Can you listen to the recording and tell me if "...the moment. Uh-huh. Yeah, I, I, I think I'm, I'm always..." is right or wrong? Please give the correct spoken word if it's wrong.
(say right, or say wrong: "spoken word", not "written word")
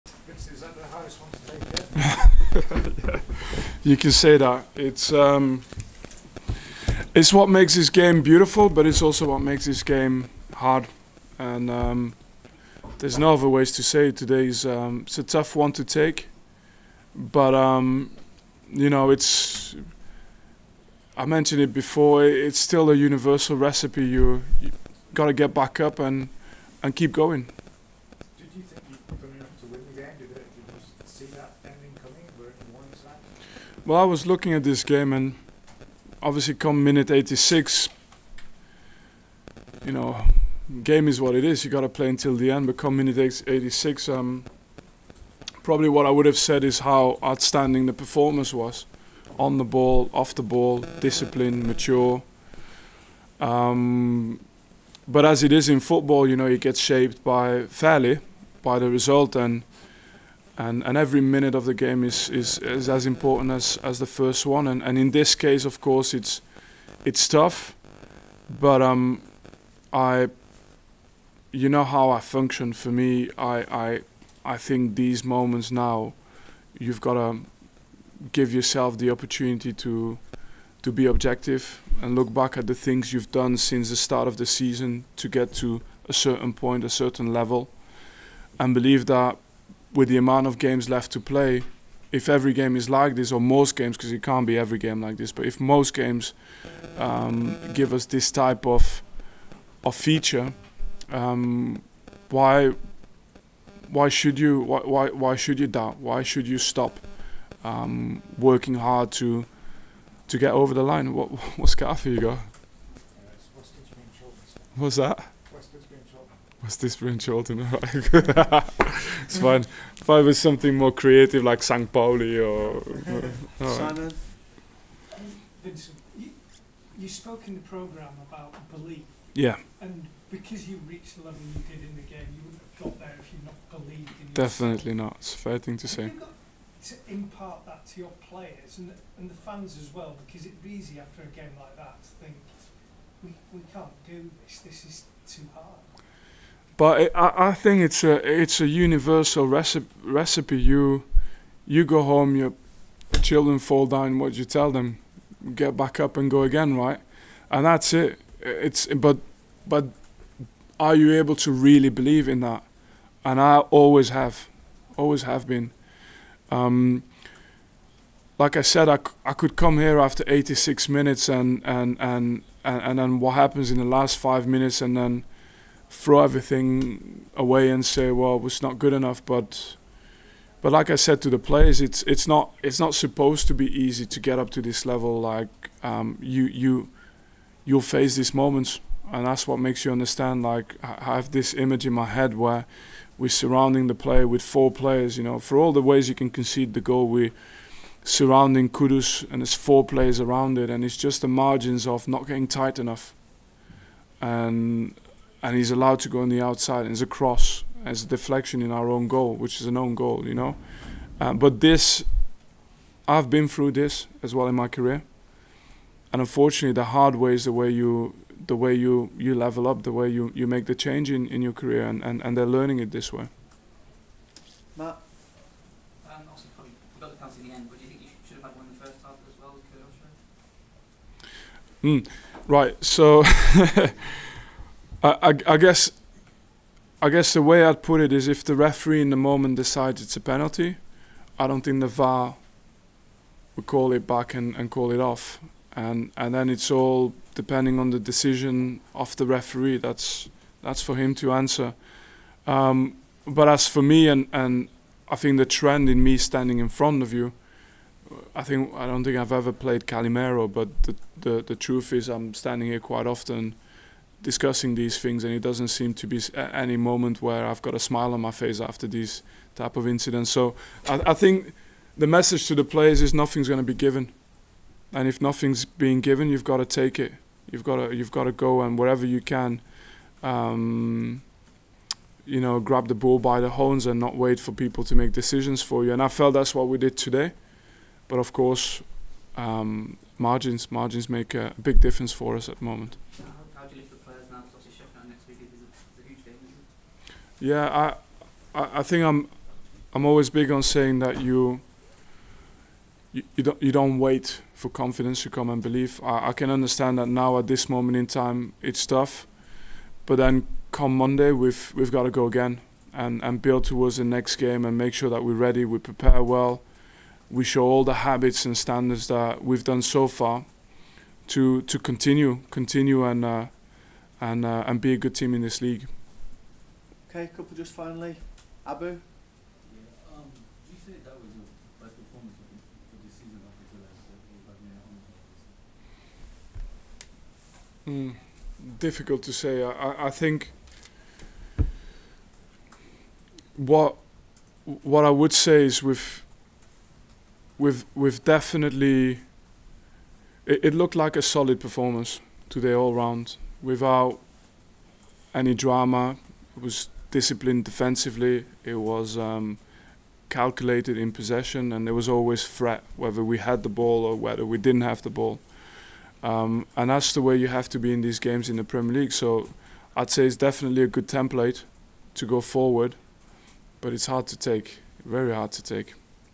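right.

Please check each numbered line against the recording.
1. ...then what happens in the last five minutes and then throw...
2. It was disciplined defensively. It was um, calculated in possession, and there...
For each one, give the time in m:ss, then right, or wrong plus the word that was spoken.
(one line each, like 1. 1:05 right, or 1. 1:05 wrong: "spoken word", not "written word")
1. 2:52 right
2. 5:56 right.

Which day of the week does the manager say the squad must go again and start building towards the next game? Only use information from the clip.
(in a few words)
Monday.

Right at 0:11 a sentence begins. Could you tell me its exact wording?
And um, there's no other ways to say it.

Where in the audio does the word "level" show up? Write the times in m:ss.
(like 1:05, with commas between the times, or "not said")
1:27, 2:11, 3:04, 3:39.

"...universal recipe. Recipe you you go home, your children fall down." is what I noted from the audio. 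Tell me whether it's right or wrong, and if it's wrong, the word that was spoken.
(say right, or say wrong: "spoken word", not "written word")
right.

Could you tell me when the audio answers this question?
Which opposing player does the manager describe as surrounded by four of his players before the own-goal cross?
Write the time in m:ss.
3:18.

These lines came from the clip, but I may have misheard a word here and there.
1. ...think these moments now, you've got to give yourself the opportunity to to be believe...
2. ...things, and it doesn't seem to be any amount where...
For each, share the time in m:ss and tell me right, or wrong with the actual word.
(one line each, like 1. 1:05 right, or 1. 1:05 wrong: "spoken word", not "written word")
1. 1:14 wrong: "objective", not "believe"
2. 4:24 wrong: "moment", not "amount".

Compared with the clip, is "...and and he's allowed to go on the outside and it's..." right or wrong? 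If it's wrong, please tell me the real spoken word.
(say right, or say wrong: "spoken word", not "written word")
right.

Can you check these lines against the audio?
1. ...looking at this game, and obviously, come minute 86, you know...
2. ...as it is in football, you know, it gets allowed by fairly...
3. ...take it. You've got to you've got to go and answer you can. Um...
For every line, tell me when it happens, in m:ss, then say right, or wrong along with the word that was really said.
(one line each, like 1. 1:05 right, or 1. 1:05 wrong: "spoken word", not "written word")
1. 0:34 right
2. 0:55 wrong: "shaped", not "allowed"
3. 4:36 wrong: "wherever", not "answer".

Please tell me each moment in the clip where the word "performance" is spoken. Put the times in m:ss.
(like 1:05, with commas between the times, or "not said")
0:47, 5:51.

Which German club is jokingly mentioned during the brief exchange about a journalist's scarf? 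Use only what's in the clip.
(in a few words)
Saint Pauli.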